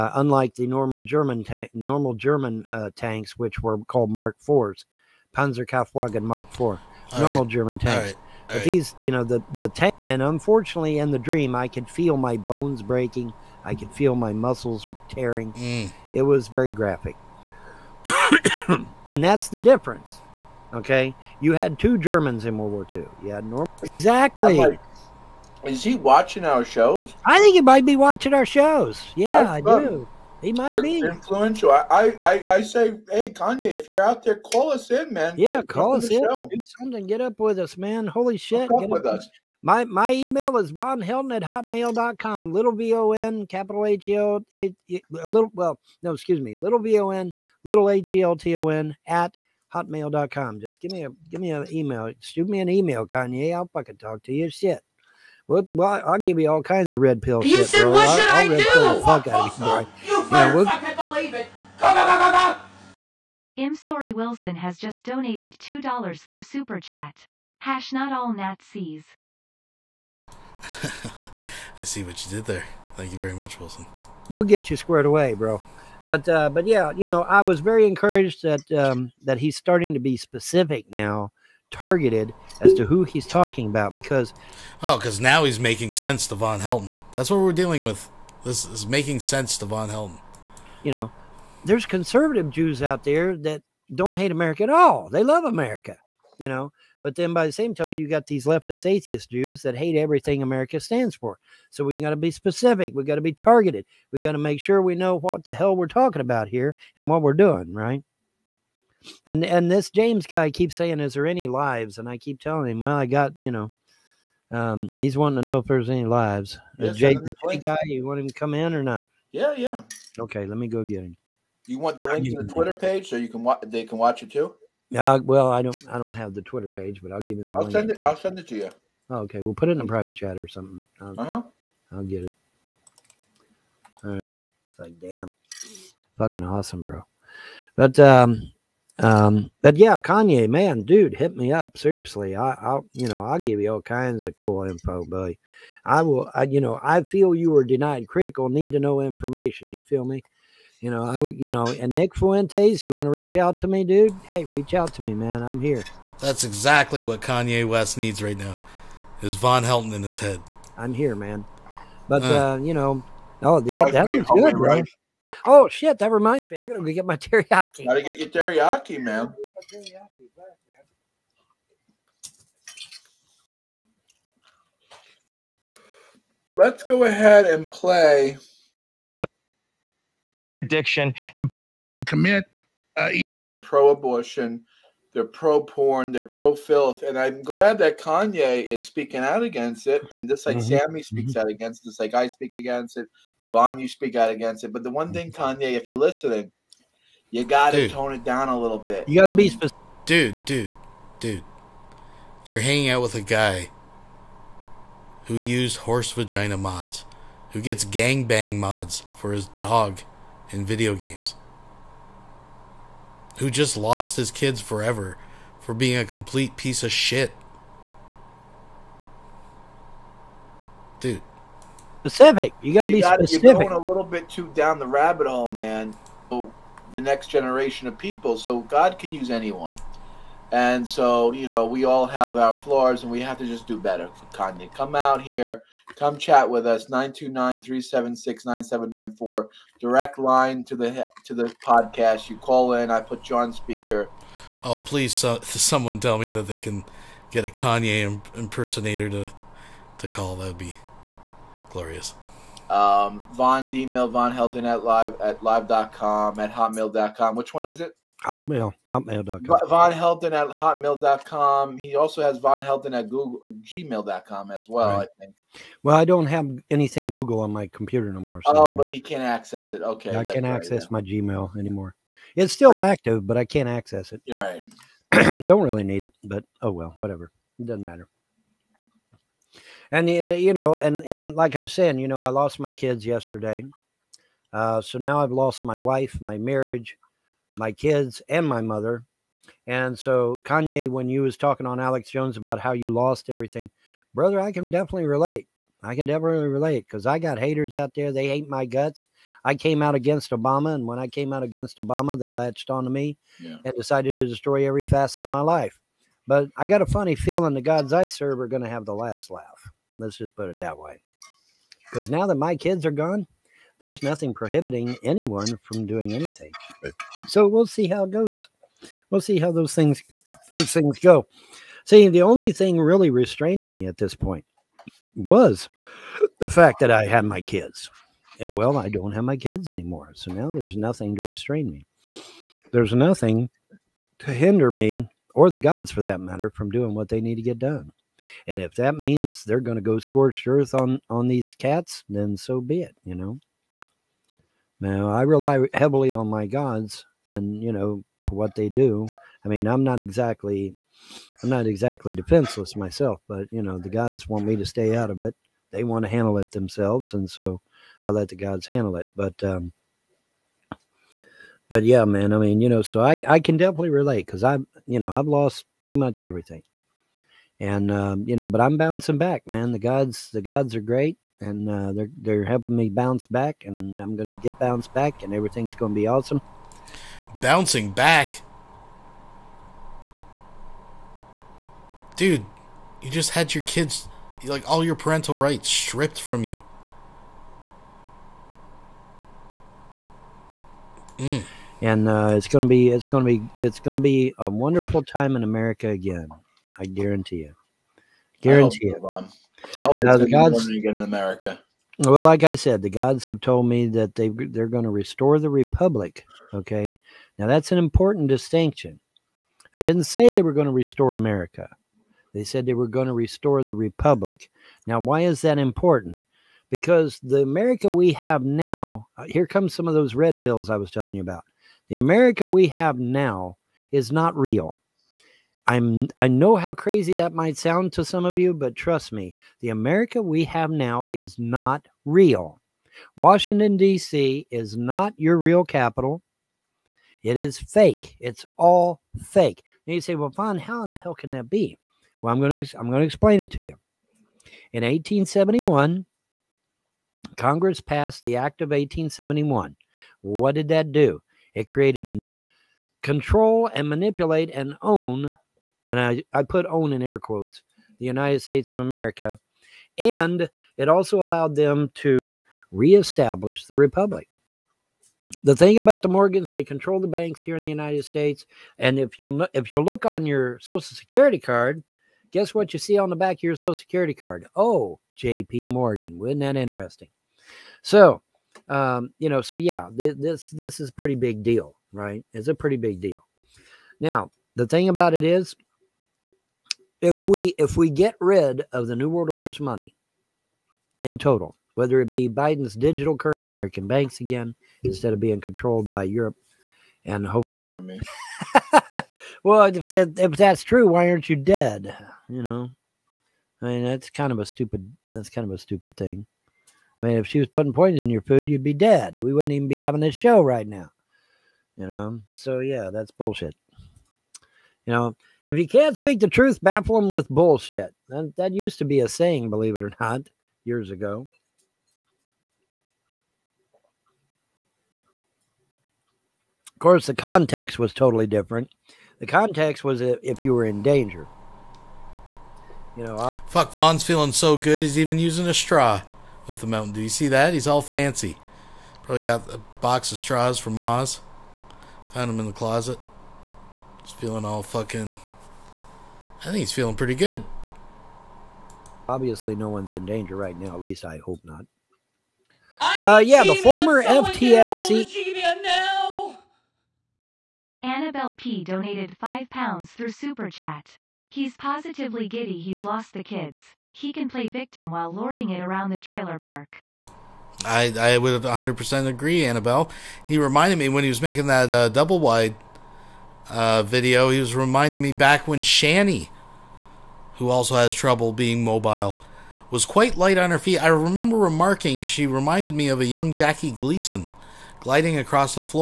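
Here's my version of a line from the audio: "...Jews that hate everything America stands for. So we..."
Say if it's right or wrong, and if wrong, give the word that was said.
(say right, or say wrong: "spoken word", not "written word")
right.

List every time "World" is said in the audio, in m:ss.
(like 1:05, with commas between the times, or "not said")
0:22, 8:09.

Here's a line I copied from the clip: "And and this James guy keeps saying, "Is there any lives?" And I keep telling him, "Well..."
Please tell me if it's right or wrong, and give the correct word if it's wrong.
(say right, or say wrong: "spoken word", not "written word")
right.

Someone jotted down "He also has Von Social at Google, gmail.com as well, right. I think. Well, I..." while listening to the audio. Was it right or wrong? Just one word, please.
wrong.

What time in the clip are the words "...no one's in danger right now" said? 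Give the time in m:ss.
9:09.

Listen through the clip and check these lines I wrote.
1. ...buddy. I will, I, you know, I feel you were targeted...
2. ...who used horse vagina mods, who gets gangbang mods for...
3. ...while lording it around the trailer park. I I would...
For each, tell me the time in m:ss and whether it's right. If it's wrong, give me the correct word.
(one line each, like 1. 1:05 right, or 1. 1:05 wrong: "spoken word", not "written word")
1. 2:25 wrong: "denied", not "targeted"
2. 3:25 right
3. 9:24 right.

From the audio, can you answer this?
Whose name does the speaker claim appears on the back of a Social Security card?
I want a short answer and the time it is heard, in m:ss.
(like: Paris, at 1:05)
J.P. Morgan, at 7:55.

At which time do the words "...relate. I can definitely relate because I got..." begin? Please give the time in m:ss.
4:55.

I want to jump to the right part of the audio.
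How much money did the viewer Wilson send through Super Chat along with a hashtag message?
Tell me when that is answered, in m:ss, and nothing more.
1:05.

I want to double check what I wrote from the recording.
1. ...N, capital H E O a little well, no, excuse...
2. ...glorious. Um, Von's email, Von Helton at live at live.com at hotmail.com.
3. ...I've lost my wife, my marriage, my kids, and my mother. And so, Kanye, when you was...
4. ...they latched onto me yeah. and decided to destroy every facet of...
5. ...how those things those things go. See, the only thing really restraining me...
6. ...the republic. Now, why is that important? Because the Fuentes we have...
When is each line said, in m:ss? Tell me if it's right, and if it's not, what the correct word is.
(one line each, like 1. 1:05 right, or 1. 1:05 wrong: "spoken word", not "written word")
1. 0:43 right
2. 4:11 right
3. 4:45 right
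4. 5:02 right
5. 5:19 right
6. 6:53 wrong: "America", not "Fuentes".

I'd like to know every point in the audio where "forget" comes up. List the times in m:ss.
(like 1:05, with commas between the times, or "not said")
not said.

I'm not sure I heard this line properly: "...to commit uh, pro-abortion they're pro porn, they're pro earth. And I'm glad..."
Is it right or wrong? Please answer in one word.
wrong.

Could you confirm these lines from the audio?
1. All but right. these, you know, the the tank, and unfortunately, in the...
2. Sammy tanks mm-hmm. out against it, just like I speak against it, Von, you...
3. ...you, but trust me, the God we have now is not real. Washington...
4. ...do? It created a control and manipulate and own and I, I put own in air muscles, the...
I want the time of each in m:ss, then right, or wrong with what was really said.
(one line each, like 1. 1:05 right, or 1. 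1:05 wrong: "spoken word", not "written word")
1. 0:08 right
2. 3:10 wrong: "speaks", not "tanks"
3. 7:08 wrong: "America", not "God"
4. 7:30 wrong: "quotes", not "muscles".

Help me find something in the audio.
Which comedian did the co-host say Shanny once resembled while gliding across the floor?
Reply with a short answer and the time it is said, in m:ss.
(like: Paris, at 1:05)
Jackie Gleason, at 9:43.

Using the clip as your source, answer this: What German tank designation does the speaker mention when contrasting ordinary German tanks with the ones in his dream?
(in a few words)
Mark IV.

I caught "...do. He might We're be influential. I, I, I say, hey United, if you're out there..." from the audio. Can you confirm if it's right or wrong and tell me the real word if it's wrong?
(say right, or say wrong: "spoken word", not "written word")
wrong: "Kanye", not "United".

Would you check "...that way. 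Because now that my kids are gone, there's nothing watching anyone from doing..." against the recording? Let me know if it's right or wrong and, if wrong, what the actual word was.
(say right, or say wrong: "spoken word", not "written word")
wrong: "prohibiting", not "watching".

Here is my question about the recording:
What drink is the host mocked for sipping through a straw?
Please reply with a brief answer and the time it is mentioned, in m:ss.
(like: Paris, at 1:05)
Mountain Dew, at 8:56.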